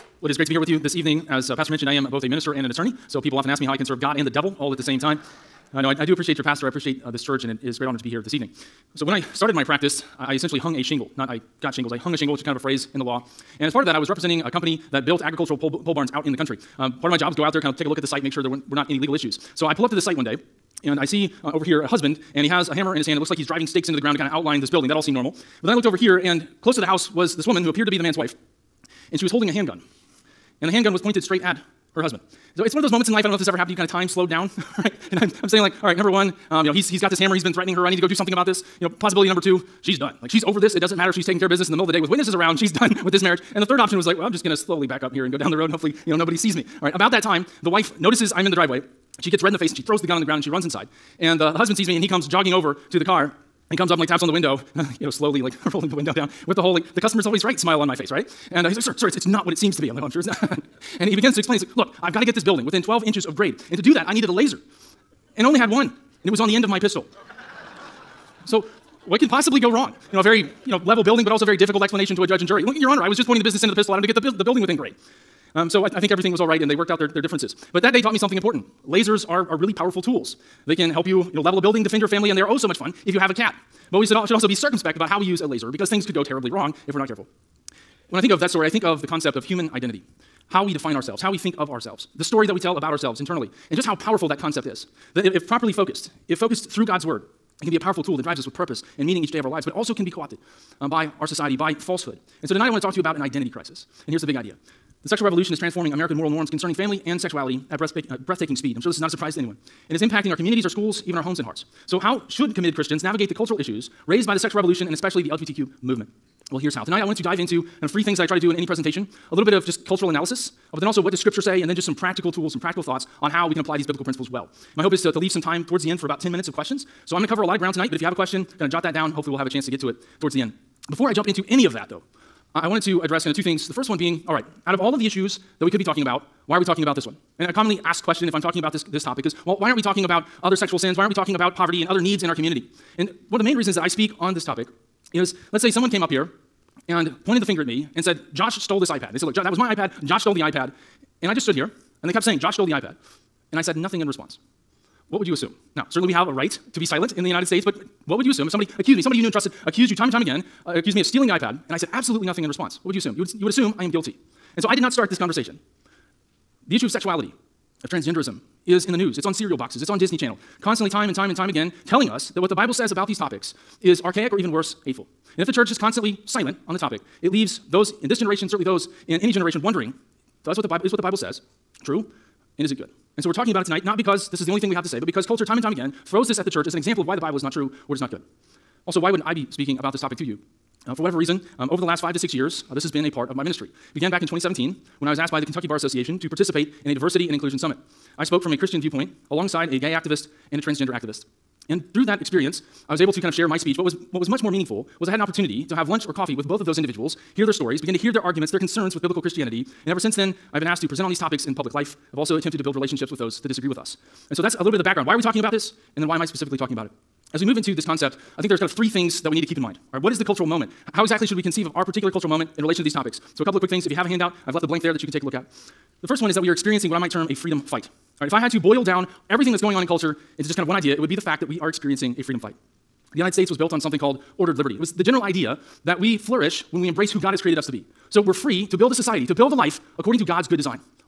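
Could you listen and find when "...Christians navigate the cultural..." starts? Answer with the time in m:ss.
1:52.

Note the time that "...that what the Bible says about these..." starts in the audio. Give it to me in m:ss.
2:52.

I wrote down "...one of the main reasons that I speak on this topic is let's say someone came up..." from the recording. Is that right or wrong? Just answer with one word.
right.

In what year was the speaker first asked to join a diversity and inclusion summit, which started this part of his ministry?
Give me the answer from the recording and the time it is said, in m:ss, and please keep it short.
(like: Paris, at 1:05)
2017, at 3:14.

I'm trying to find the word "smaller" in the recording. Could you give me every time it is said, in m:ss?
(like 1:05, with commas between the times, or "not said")
not said.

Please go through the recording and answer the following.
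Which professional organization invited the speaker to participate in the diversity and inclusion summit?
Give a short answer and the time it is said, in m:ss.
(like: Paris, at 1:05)
Kentucky Bar Association, at 3:15.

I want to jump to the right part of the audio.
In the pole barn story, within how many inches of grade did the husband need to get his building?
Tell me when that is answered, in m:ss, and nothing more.
1:02.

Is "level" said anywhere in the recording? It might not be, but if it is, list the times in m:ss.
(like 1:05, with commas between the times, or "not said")
1:10, 1:21.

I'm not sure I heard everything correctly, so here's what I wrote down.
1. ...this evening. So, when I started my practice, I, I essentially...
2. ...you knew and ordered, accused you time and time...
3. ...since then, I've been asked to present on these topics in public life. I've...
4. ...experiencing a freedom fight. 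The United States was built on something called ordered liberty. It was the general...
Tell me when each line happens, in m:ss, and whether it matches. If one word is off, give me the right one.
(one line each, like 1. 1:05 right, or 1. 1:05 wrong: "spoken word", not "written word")
1. 0:08 right
2. 2:39 wrong: "trusted", not "ordered"
3. 3:29 right
4. 3:51 right.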